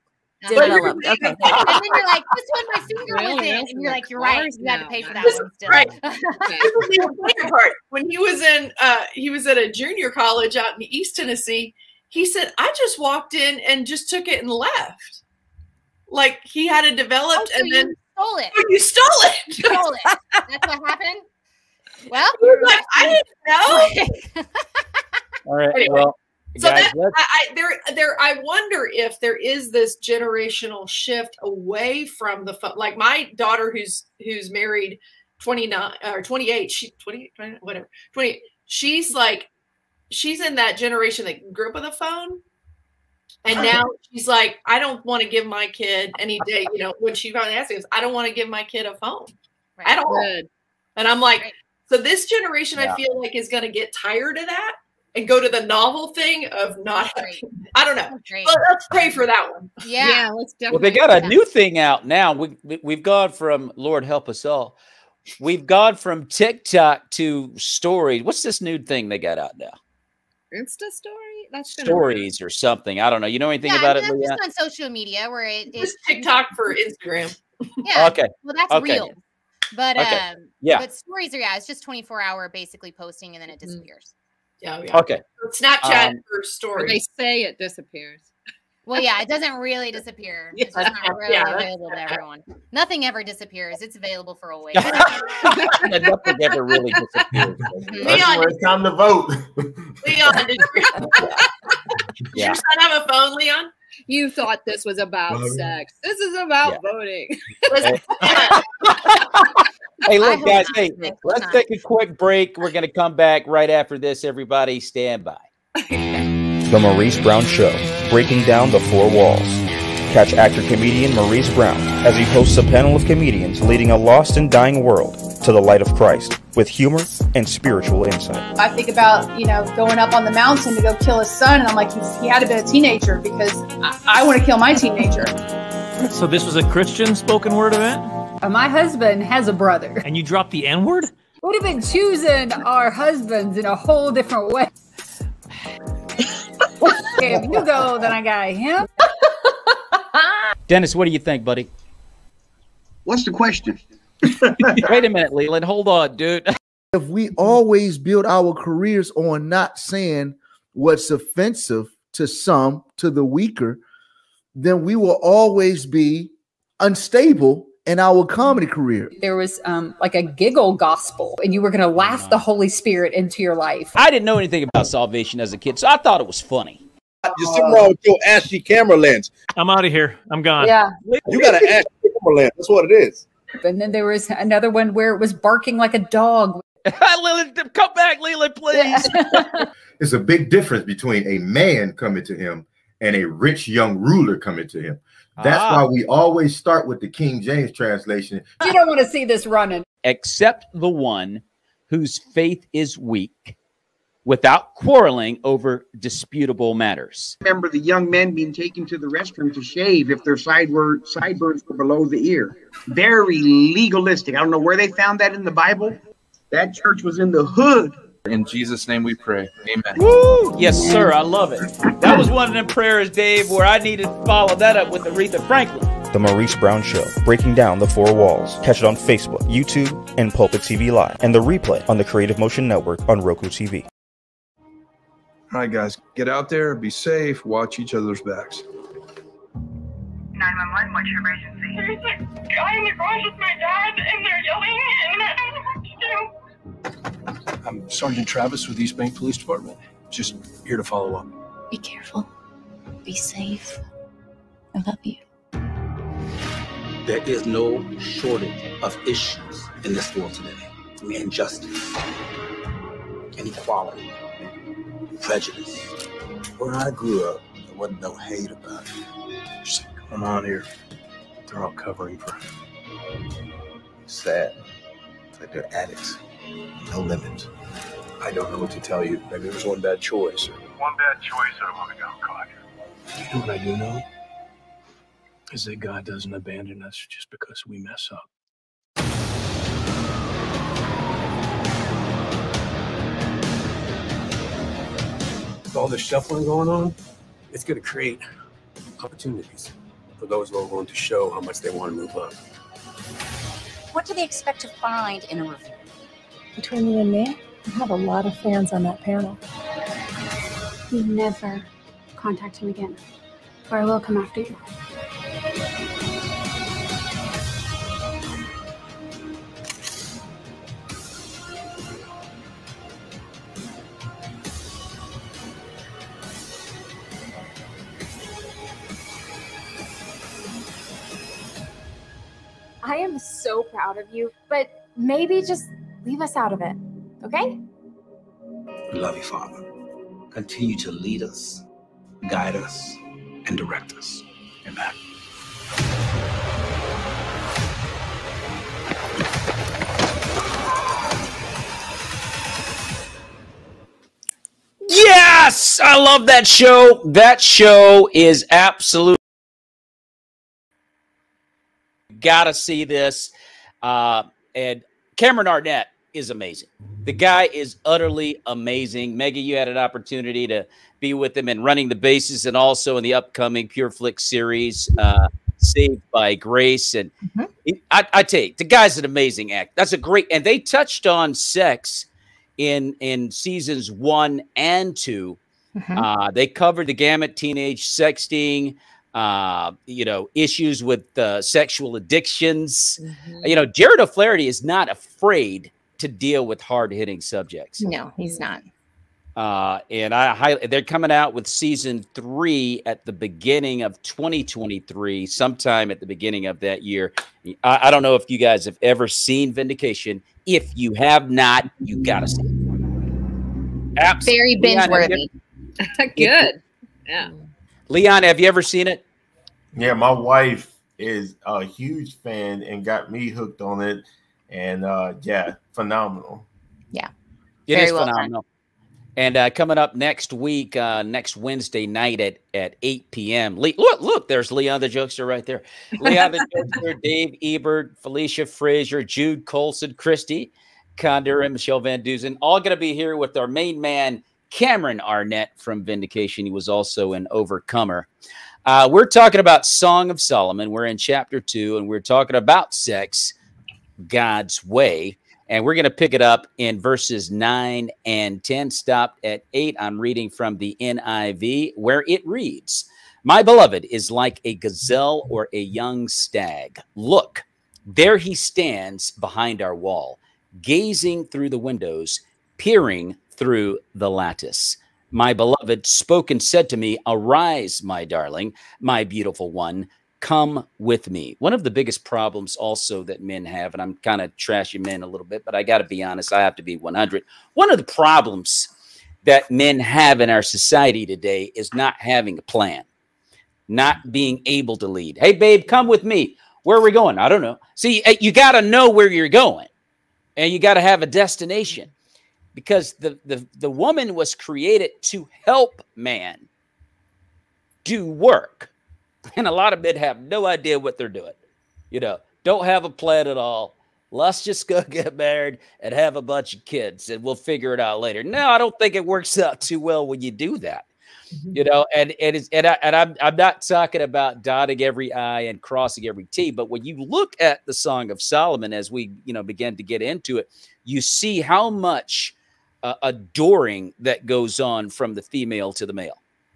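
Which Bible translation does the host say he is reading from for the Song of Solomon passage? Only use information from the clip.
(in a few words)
NIV.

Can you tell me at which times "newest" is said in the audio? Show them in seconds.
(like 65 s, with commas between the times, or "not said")
not said.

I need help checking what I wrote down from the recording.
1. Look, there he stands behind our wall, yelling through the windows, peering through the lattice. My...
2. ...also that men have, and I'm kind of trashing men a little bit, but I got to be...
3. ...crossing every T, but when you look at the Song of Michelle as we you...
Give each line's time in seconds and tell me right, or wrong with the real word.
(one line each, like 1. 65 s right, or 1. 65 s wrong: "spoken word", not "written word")
1. 466 s wrong: "gazing", not "yelling"
2. 482 s right
3. 525 s wrong: "Solomon", not "Michelle".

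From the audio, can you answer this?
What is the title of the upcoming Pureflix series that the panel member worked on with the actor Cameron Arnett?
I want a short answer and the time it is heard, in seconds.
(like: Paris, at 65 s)
Saved by Grace, at 375 s.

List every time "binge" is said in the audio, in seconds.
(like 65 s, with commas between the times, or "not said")
414 s.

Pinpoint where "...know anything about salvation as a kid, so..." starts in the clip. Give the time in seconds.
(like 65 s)
174 s.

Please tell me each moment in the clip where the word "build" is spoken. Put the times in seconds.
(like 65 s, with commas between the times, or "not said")
157 s.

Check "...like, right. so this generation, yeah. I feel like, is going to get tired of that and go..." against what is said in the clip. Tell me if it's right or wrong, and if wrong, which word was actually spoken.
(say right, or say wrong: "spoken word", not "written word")
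right.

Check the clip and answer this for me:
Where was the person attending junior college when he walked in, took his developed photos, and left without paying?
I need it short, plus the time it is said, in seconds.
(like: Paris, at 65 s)
East Tennessee, at 10 s.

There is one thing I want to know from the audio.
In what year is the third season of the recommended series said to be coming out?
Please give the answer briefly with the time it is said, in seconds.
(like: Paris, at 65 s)
2023, at 404 s.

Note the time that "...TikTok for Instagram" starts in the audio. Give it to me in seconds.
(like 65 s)
76 s.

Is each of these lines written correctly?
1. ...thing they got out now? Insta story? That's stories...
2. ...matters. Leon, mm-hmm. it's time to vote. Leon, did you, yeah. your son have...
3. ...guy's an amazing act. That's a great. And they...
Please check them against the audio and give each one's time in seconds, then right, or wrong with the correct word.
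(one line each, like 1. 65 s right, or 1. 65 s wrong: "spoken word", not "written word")
1. 68 s right
2. 96 s wrong: "disappears", not "matters"
3. 378 s right.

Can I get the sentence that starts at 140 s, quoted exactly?
And you dropped the N word?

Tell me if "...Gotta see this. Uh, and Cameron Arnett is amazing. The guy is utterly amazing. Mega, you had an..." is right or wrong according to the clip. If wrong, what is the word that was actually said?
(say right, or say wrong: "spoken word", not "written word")
right.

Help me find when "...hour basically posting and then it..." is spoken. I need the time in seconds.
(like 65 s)
82 s.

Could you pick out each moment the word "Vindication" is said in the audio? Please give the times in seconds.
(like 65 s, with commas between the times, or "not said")
409 s, 445 s.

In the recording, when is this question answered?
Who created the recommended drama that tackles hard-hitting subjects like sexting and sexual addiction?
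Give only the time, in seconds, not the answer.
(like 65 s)
393 s.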